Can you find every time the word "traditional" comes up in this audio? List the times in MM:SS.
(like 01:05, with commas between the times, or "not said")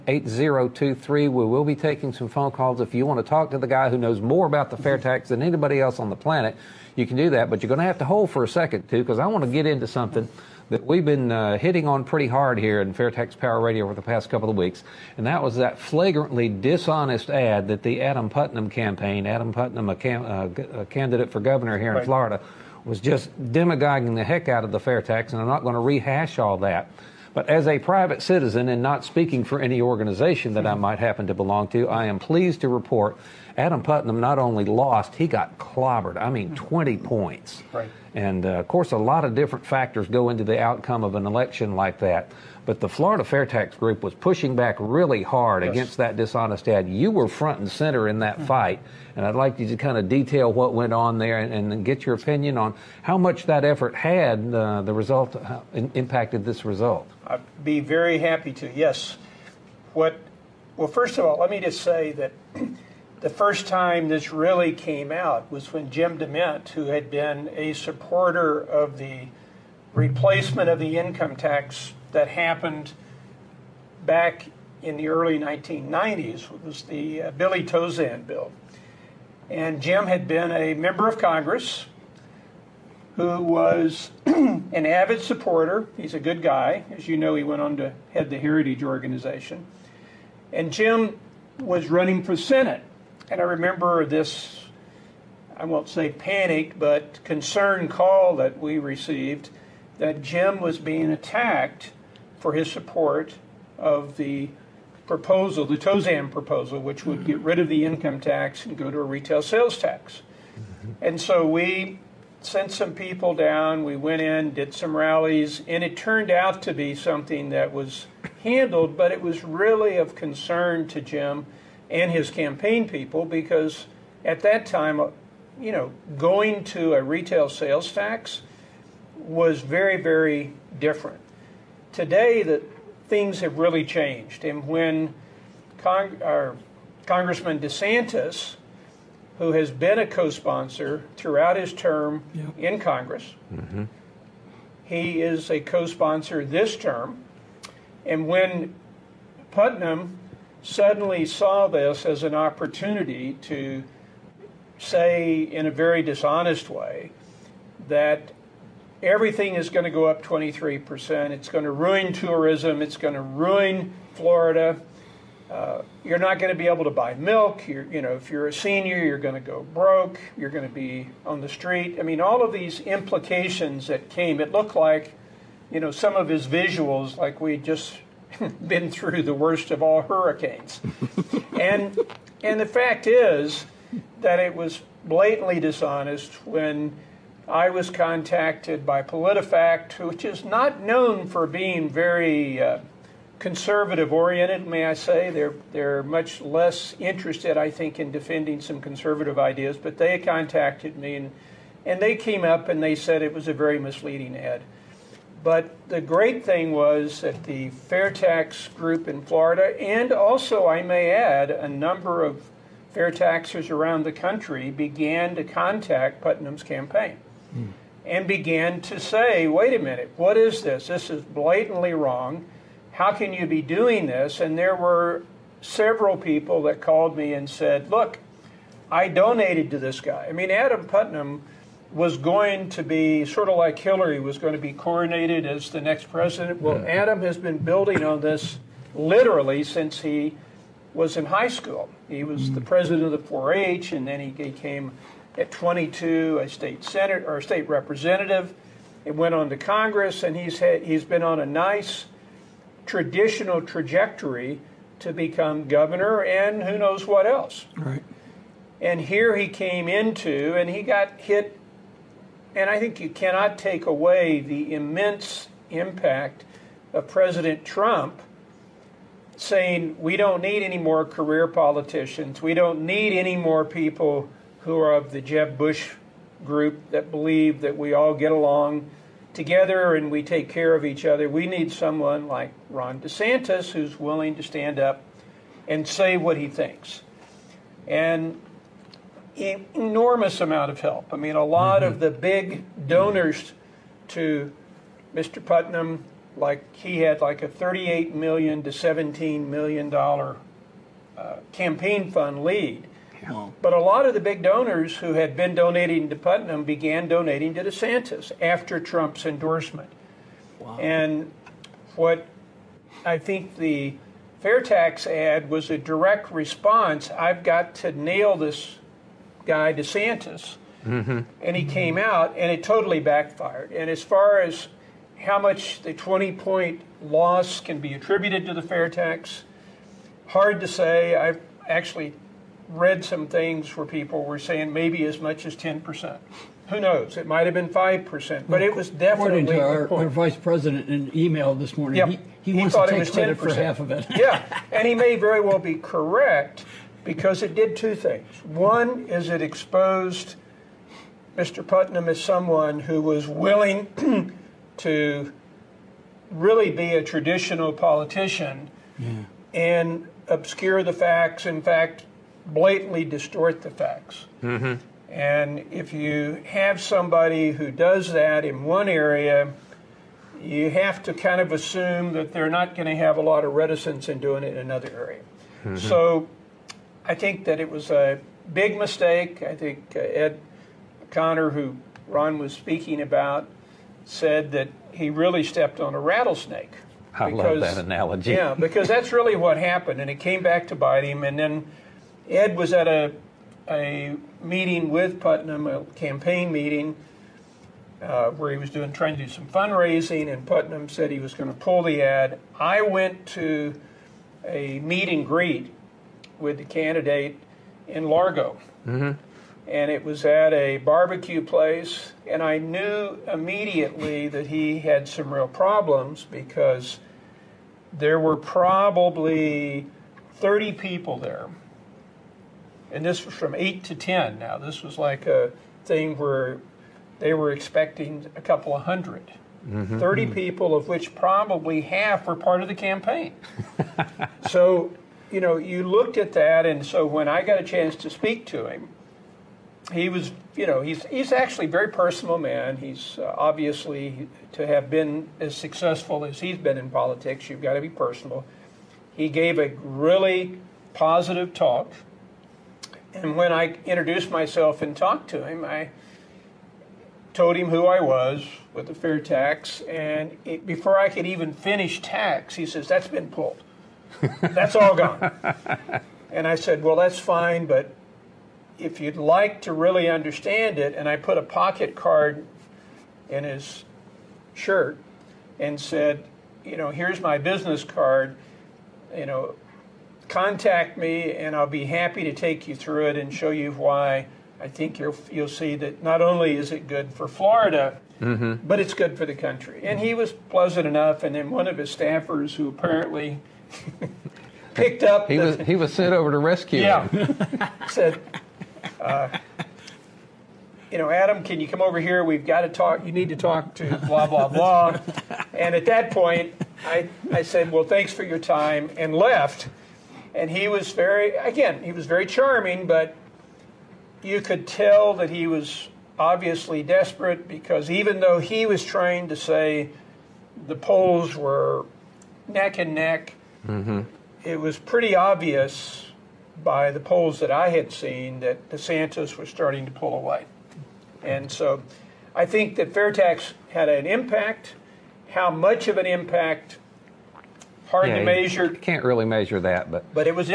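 04:12, 05:57.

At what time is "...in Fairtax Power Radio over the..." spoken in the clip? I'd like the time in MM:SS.
00:12.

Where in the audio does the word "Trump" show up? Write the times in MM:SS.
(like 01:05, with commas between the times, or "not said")
04:27, 05:08.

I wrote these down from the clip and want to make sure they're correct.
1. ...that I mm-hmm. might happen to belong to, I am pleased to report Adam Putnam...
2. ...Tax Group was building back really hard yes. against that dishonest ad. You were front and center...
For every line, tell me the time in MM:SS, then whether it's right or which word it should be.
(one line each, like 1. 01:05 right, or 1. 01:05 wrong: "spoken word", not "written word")
1. 00:30 right
2. 00:43 wrong: "pushing", not "building".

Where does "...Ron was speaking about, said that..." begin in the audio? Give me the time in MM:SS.
06:22.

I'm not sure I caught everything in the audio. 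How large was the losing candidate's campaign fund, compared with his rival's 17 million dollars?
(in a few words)
38 million dollars.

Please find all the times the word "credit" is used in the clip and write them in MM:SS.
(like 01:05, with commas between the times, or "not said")
05:43.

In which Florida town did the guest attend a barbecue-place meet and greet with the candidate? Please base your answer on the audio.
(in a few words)
Largo.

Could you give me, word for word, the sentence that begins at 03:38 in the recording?
and began to say, wait a minute, what is this?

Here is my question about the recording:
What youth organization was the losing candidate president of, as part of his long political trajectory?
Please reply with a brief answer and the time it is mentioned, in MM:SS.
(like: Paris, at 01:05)
4-H, at 04:03.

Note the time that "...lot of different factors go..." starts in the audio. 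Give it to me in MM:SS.
00:38.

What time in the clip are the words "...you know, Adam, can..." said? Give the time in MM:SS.
08:20.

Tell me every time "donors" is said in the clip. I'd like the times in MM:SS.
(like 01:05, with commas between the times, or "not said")
04:52, 05:04.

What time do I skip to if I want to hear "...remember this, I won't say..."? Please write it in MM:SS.
01:33.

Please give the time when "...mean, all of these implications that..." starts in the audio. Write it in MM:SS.
02:52.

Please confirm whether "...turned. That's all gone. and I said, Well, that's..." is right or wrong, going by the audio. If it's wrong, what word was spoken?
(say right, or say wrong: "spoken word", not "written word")
wrong: "pulled", not "turned".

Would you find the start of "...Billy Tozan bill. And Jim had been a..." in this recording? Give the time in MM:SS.
01:17.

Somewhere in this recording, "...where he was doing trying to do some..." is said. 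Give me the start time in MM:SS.
06:38.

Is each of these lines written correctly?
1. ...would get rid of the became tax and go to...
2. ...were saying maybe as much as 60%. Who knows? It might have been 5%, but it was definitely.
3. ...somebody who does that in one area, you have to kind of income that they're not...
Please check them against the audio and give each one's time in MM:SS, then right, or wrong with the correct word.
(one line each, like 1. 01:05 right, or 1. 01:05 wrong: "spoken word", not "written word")
1. 01:47 wrong: "income", not "became"
2. 05:34 wrong: "10", not "60"
3. 06:06 wrong: "assume", not "income".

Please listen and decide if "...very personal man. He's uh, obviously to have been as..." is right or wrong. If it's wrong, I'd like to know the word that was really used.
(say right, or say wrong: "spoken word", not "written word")
right.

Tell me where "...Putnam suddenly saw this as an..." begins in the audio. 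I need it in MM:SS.
02:29.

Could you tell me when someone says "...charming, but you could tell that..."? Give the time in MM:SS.
08:32.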